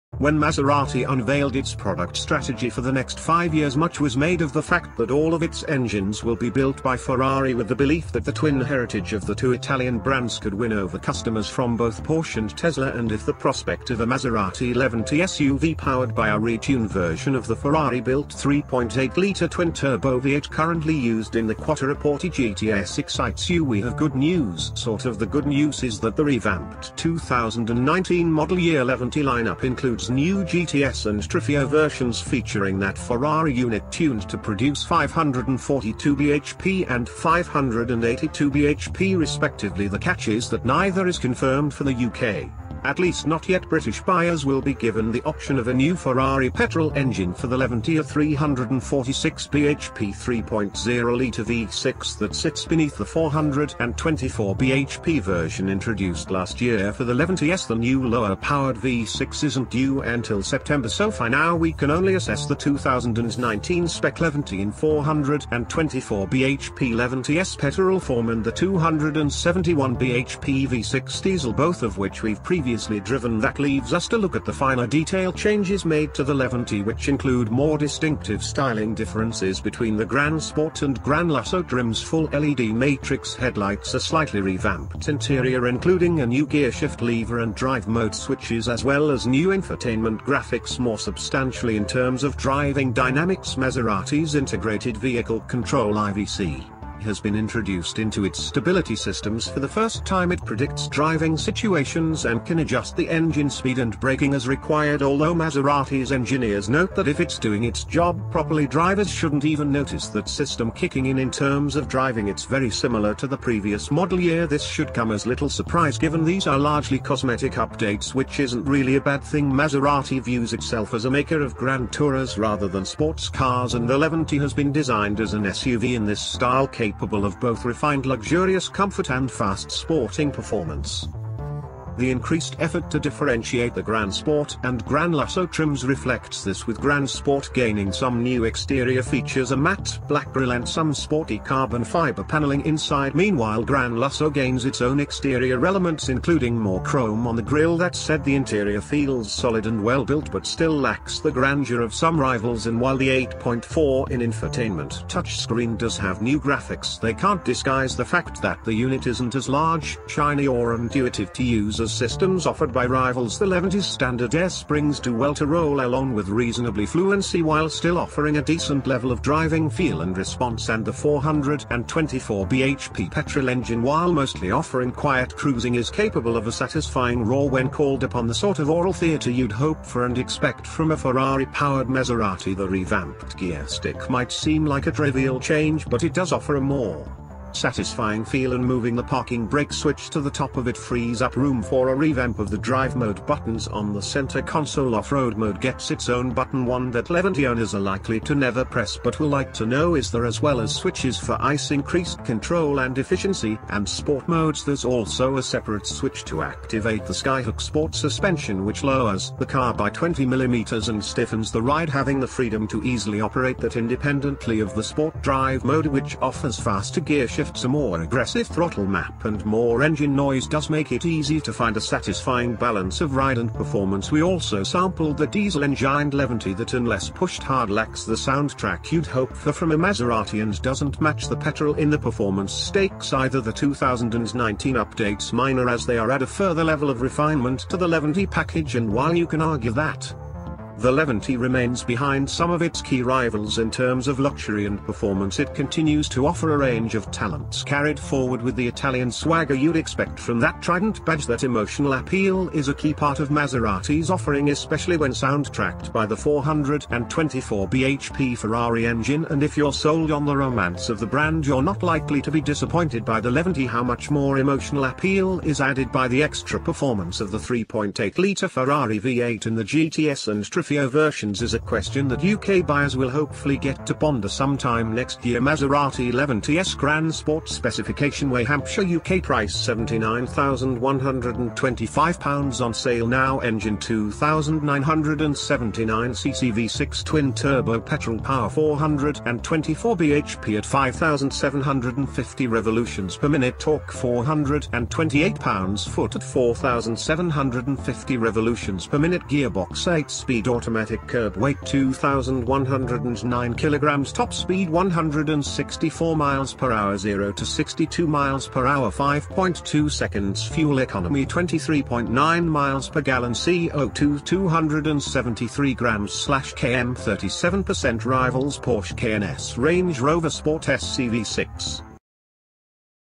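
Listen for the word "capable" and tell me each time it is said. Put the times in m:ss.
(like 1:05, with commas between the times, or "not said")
2:06, 2:55.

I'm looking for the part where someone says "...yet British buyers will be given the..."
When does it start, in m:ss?
0:43.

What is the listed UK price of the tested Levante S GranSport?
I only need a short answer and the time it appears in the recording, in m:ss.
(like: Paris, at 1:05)
£79,125, at 4:39.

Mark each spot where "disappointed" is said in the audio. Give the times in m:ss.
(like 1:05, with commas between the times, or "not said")
4:22.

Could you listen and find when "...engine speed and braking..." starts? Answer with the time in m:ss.
1:43.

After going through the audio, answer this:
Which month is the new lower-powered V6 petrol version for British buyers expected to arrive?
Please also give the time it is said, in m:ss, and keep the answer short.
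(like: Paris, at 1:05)
September, at 1:00.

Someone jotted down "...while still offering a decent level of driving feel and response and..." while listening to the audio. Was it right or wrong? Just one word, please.
right.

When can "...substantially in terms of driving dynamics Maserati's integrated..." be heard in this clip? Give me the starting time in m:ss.
1:30.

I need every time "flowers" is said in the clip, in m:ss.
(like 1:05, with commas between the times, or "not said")
not said.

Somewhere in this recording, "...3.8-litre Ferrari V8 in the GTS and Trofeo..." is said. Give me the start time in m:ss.
4:27.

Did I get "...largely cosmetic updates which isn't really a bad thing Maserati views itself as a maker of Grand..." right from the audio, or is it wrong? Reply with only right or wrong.
right.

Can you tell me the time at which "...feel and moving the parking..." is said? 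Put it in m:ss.
3:08.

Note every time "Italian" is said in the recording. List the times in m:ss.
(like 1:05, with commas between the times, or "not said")
0:09, 4:08.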